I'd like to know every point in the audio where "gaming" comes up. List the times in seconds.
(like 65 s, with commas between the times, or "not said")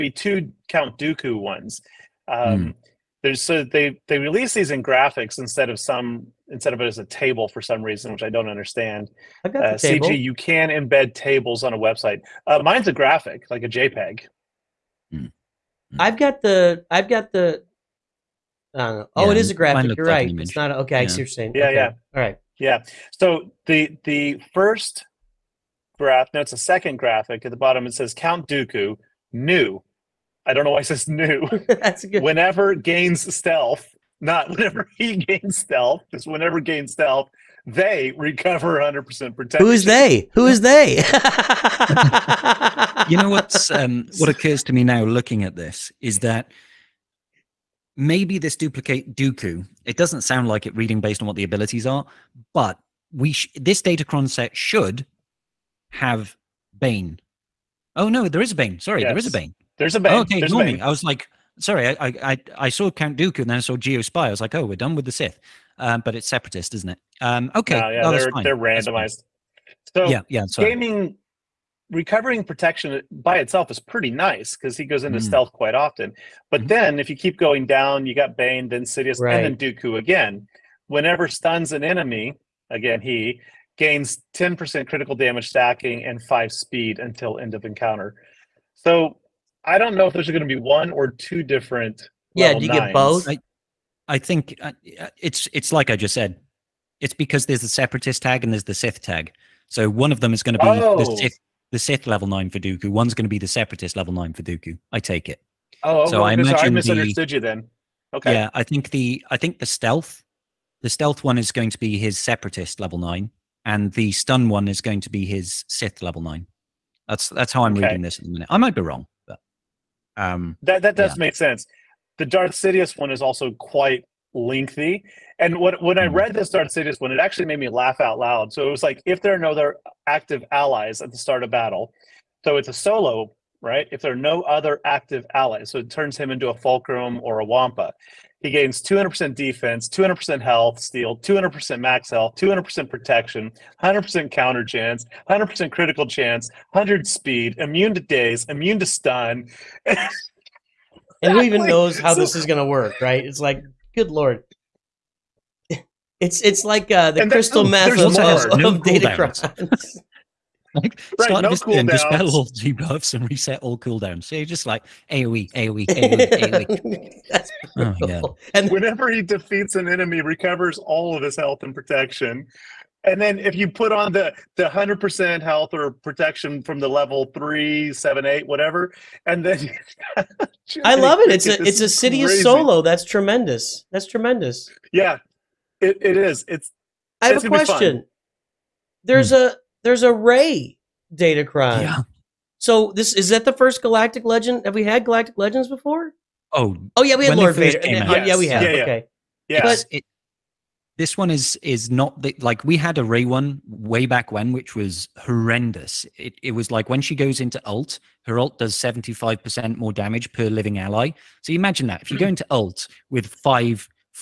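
70 s.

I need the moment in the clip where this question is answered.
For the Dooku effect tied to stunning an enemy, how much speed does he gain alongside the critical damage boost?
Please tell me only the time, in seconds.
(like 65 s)
86 s.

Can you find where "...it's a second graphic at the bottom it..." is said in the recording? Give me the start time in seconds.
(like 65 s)
26 s.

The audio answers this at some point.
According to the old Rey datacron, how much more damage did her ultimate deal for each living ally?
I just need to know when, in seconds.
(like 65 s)
208 s.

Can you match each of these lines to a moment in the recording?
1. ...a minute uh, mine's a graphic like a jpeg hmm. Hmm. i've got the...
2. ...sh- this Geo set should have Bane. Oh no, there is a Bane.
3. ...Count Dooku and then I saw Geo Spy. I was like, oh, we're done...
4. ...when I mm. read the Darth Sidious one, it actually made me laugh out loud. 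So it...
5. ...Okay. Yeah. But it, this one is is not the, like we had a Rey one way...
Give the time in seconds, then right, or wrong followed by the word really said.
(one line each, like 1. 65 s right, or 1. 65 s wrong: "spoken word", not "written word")
1. 11 s wrong: "website", not "minute"
2. 53 s wrong: "Datacron", not "Geo"
3. 62 s right
4. 125 s right
5. 198 s right.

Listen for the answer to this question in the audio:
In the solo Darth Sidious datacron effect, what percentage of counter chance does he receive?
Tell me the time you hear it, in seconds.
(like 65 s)
143 s.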